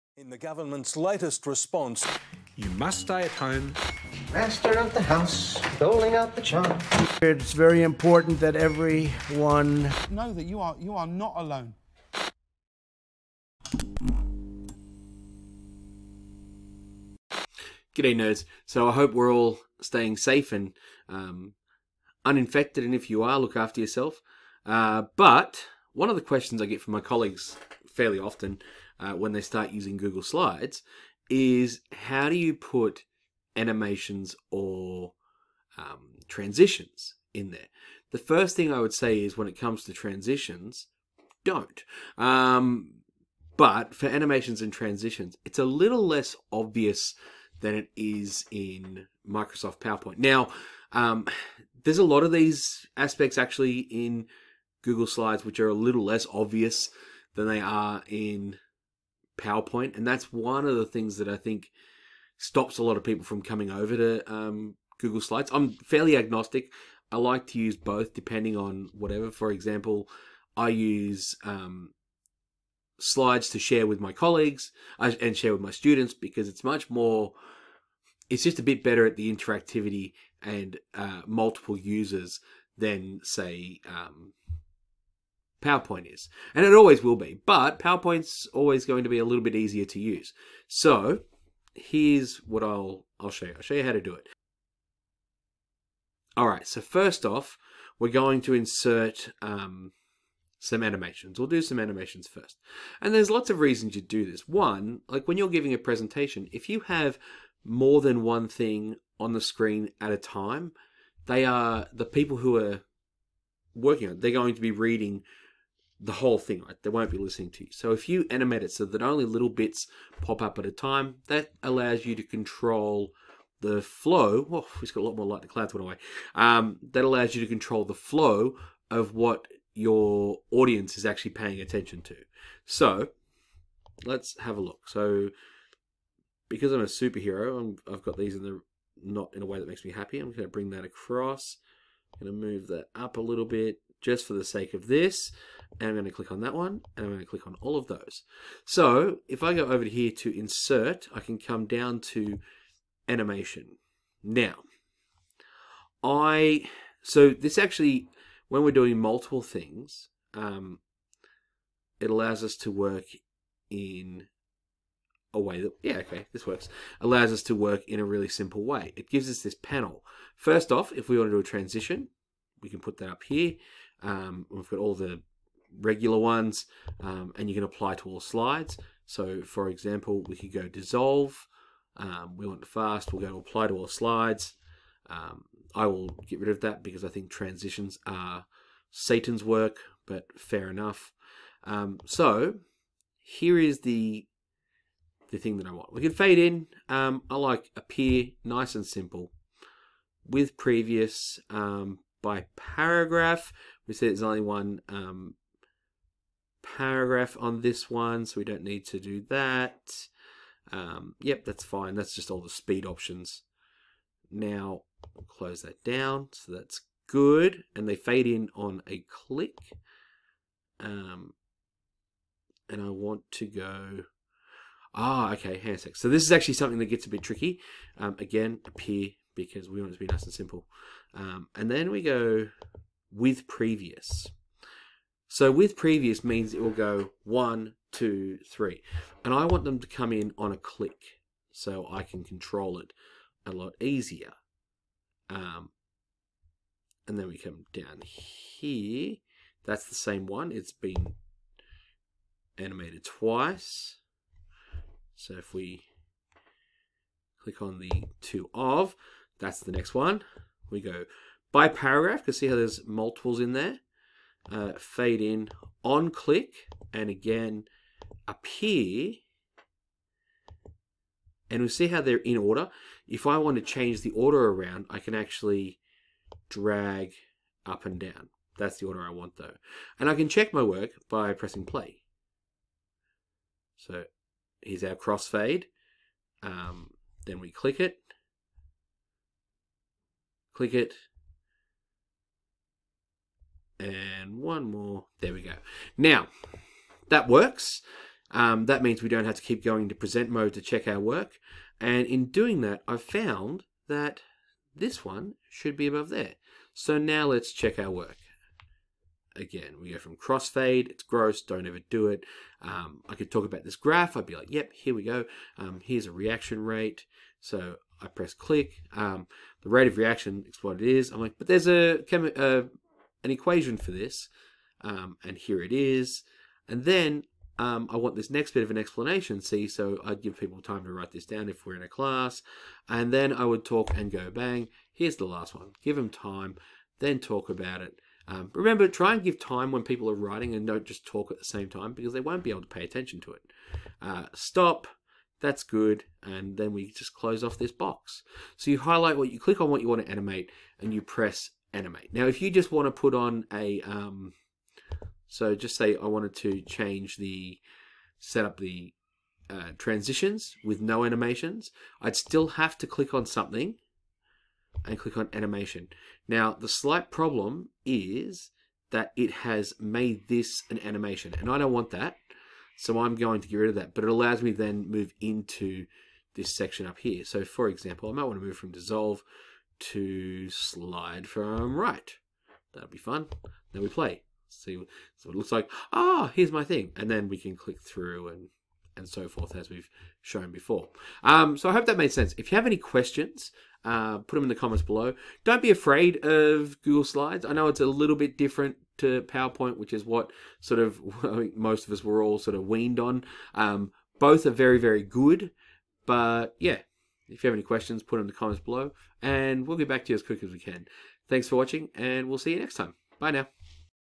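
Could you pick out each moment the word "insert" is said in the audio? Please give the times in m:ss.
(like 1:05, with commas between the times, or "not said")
1:38, 2:30.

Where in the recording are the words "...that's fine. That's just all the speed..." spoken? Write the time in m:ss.
3:31.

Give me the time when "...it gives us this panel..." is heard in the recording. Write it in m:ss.
2:48.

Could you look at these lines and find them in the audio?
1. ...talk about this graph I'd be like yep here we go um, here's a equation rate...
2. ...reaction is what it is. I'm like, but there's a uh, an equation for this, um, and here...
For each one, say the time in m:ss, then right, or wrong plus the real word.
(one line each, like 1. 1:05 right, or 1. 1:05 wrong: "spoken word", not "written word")
1. 5:13 wrong: "reaction", not "equation"
2. 5:19 right.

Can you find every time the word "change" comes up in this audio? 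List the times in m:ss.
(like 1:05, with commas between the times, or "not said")
4:33, 5:56.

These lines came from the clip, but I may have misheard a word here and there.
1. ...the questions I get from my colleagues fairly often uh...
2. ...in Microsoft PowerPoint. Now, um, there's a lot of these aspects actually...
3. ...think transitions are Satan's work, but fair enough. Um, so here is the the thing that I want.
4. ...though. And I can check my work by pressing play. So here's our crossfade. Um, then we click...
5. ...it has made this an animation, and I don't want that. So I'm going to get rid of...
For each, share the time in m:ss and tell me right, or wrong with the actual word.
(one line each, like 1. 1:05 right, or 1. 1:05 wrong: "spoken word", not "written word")
1. 0:26 right
2. 0:48 right
3. 3:07 right
4. 4:39 right
5. 6:09 right.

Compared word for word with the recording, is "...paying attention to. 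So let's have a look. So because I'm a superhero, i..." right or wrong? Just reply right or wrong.
right.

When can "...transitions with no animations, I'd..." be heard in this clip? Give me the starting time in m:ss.
5:59.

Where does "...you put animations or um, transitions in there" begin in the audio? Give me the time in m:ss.
0:32.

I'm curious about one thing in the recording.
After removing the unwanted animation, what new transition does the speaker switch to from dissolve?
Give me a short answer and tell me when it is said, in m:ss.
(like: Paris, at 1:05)
Slide from right, at 6:20.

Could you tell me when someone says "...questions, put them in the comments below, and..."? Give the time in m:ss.
6:47.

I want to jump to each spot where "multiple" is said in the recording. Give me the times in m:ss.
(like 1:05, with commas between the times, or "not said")
1:21, 2:38, 4:22.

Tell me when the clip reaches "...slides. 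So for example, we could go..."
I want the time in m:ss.
2:58.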